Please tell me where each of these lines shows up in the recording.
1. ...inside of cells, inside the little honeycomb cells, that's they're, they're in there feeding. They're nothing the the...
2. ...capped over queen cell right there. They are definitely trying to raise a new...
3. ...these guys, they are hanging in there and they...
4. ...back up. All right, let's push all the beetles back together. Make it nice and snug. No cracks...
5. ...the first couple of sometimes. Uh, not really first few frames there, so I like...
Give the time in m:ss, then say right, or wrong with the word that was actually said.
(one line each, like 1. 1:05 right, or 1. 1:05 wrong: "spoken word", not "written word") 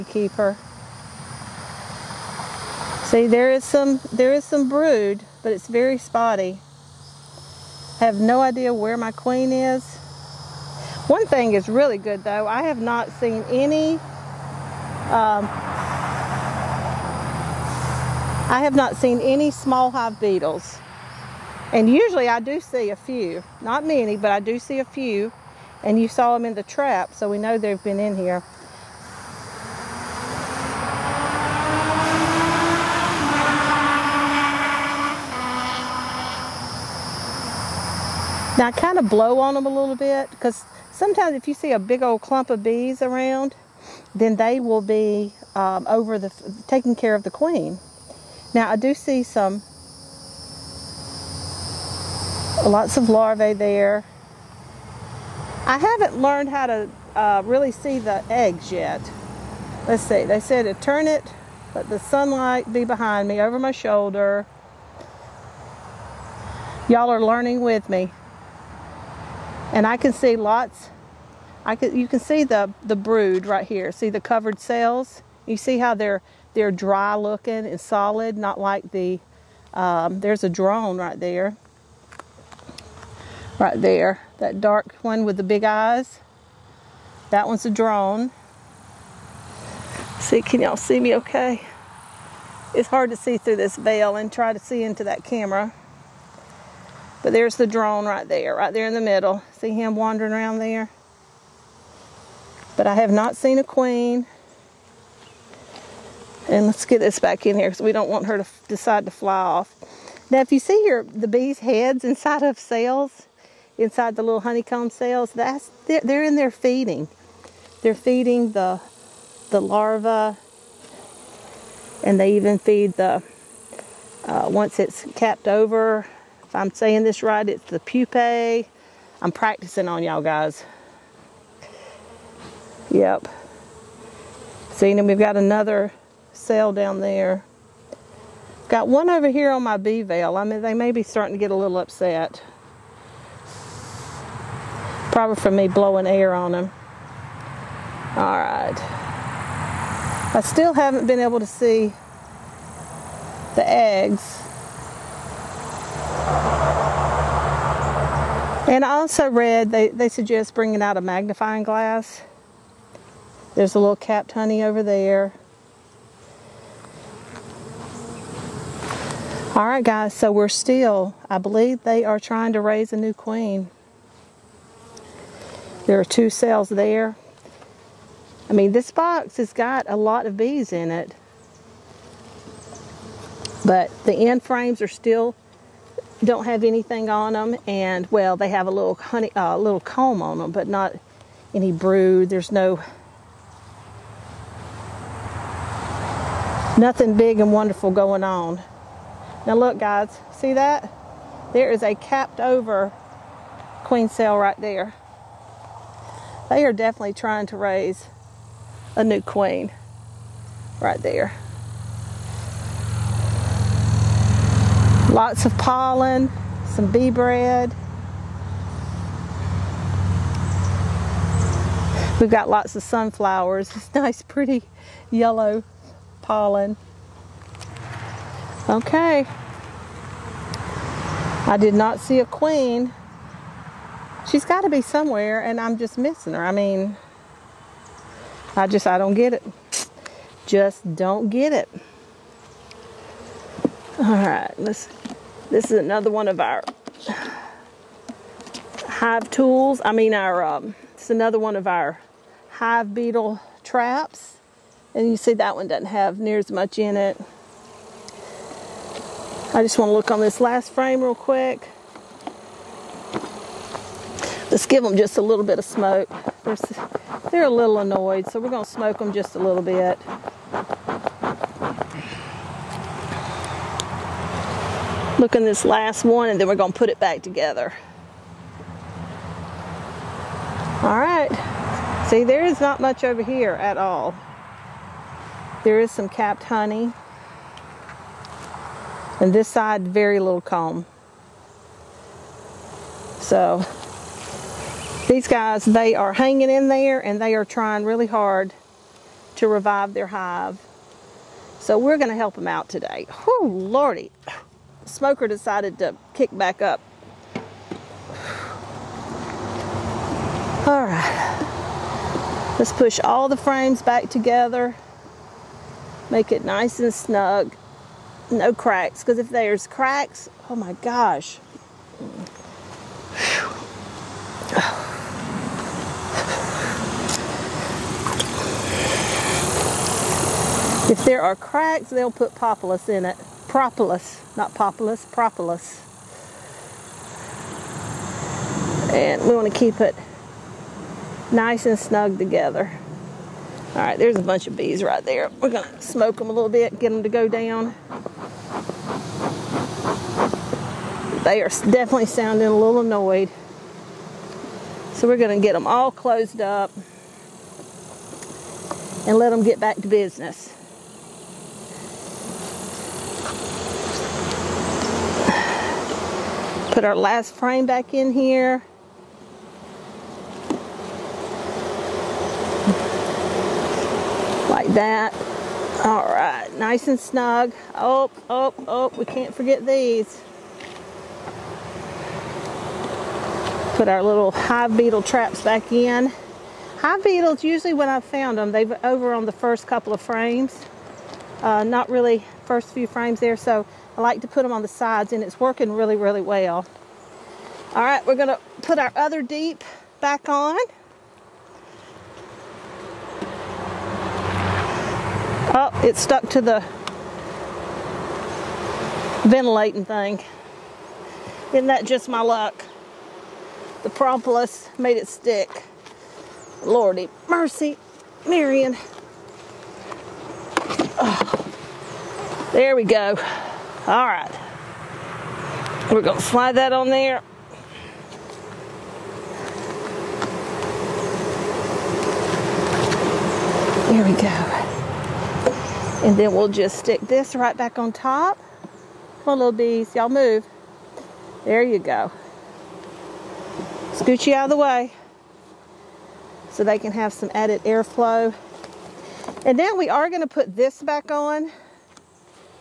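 1. 1:52 wrong: "feeding", not "nothing"
2. 3:21 right
3. 4:55 right
4. 5:06 wrong: "frames", not "beetles"
5. 6:29 wrong: "frames", not "sometimes".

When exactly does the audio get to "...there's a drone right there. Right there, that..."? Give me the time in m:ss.
1:20.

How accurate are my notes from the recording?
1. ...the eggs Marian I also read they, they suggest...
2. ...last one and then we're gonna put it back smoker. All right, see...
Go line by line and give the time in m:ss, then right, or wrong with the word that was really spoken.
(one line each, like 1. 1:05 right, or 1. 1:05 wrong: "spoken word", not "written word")
1. 2:33 wrong: "And", not "Marian"
2. 4:35 wrong: "together", not "smoker".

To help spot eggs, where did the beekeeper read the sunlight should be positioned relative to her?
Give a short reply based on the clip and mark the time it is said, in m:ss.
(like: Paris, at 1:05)
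over my shoulder, at 1:03.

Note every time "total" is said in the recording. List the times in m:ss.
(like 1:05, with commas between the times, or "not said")
not said.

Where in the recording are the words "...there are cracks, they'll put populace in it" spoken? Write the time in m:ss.
5:31.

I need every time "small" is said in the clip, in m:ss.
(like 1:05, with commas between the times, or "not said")
0:19.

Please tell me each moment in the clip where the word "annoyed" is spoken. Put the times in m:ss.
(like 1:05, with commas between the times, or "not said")
4:27, 5:52.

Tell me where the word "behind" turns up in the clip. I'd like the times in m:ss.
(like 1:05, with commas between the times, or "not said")
1:02.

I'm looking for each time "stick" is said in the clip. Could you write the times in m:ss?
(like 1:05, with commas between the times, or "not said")
6:55, 7:16.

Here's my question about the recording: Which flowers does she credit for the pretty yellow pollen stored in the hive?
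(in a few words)
sunflowers.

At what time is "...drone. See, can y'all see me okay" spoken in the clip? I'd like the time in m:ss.
1:27.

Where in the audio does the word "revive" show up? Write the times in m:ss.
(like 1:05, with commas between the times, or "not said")
4:59.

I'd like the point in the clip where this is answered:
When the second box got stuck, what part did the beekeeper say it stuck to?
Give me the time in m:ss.
6:49.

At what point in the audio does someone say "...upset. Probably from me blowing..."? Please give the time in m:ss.
2:21.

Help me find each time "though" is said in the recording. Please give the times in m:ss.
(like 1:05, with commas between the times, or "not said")
0:12.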